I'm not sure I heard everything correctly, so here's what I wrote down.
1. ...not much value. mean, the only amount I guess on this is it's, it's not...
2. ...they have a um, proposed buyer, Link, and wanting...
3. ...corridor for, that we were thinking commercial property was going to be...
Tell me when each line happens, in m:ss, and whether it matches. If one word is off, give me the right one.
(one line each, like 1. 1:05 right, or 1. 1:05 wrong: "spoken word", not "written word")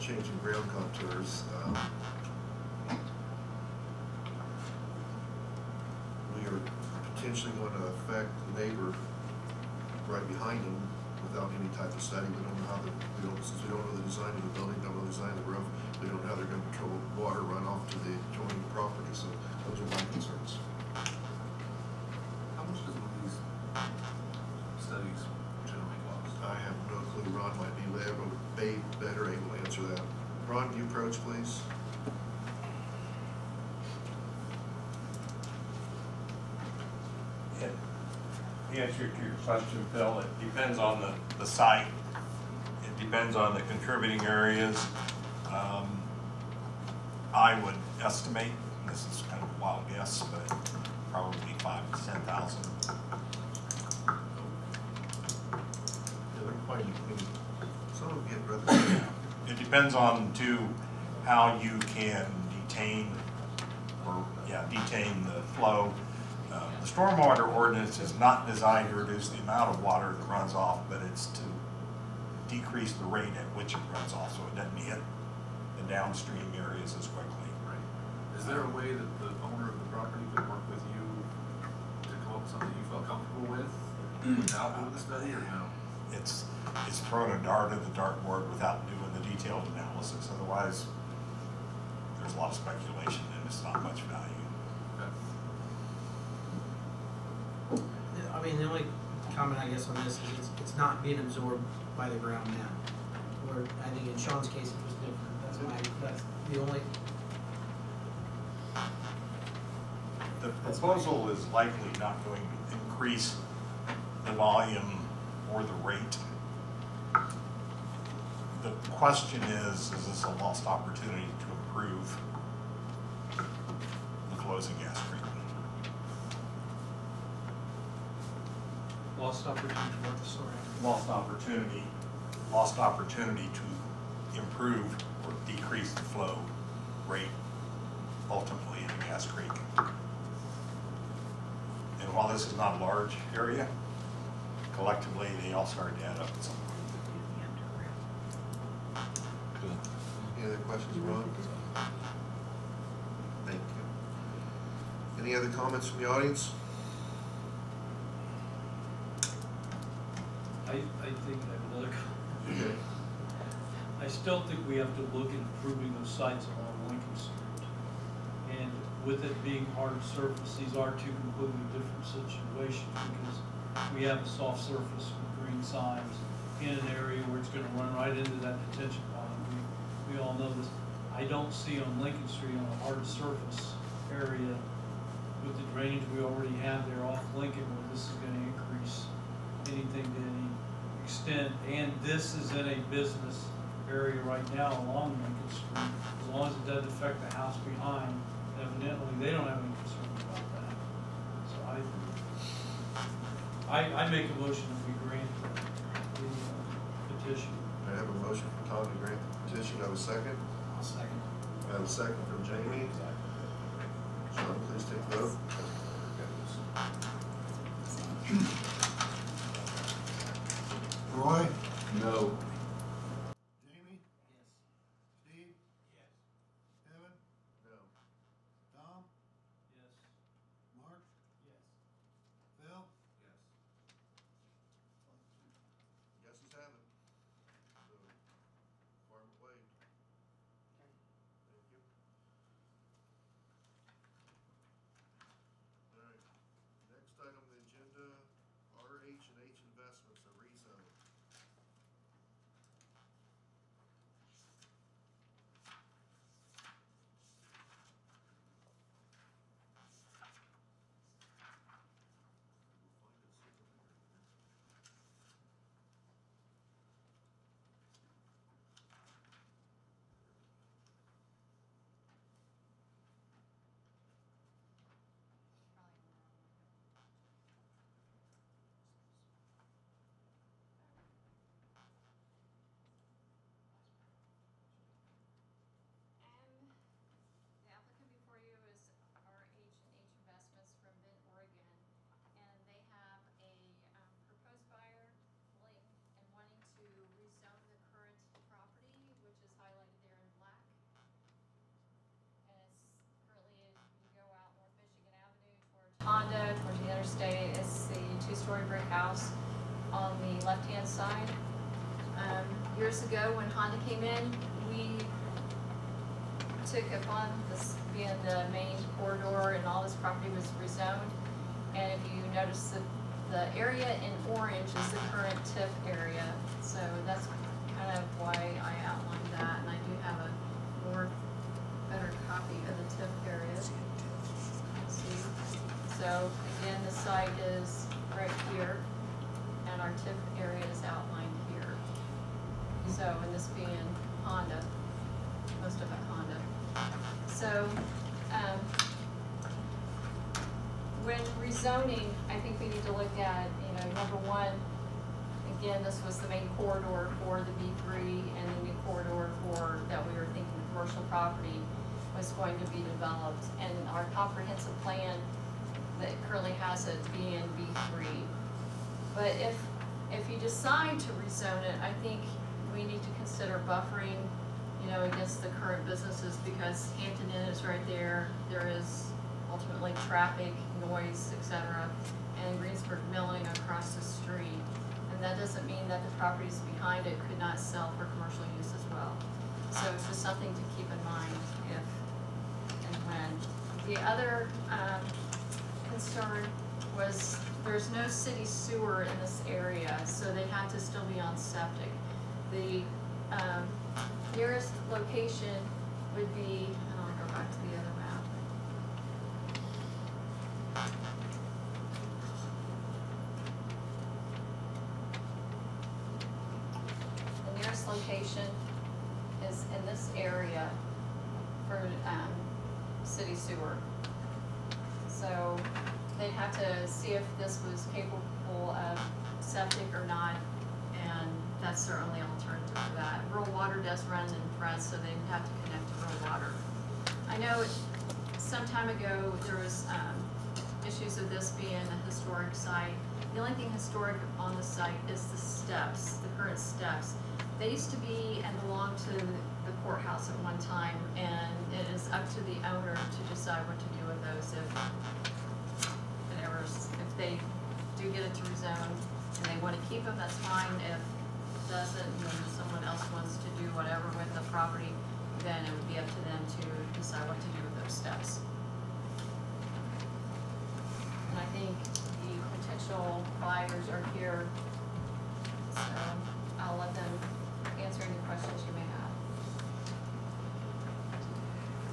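1. 1:33 wrong: "comment", not "amount"
2. 4:52 right
3. 5:58 right.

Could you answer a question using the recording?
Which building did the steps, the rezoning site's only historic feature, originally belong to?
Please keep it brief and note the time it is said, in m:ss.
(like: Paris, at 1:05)
The courthouse, at 7:29.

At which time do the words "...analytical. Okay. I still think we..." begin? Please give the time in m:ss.
2:41.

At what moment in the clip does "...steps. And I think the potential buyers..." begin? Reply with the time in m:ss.
7:47.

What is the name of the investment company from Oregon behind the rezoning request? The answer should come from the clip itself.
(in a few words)
RH and H Investments.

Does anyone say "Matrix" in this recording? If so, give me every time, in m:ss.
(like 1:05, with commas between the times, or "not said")
not said.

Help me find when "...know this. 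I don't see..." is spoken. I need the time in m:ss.
3:00.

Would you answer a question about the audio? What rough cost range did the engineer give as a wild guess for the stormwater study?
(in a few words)
5,000 to 10,000.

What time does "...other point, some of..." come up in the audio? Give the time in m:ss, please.
0:56.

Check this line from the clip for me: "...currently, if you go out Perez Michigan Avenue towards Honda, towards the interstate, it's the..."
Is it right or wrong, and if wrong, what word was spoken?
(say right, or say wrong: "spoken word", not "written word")
wrong: "North", not "Perez".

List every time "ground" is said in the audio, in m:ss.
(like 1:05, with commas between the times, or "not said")
0:00, 1:42.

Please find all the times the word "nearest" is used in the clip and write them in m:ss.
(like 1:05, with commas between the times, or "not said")
6:44, 6:57.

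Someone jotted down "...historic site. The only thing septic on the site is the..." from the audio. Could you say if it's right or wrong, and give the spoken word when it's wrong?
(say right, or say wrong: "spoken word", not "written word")
wrong: "historic", not "septic".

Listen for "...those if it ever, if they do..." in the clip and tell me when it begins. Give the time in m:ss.
7:34.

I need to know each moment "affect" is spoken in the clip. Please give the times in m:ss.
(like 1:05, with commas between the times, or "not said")
0:07, 3:16.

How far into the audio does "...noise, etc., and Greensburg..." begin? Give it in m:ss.
6:20.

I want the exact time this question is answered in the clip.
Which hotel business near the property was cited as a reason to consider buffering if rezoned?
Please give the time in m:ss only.
6:16.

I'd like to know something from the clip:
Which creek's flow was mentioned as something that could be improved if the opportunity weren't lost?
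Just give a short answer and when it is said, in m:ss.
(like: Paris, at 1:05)
Cass Creek, at 2:19.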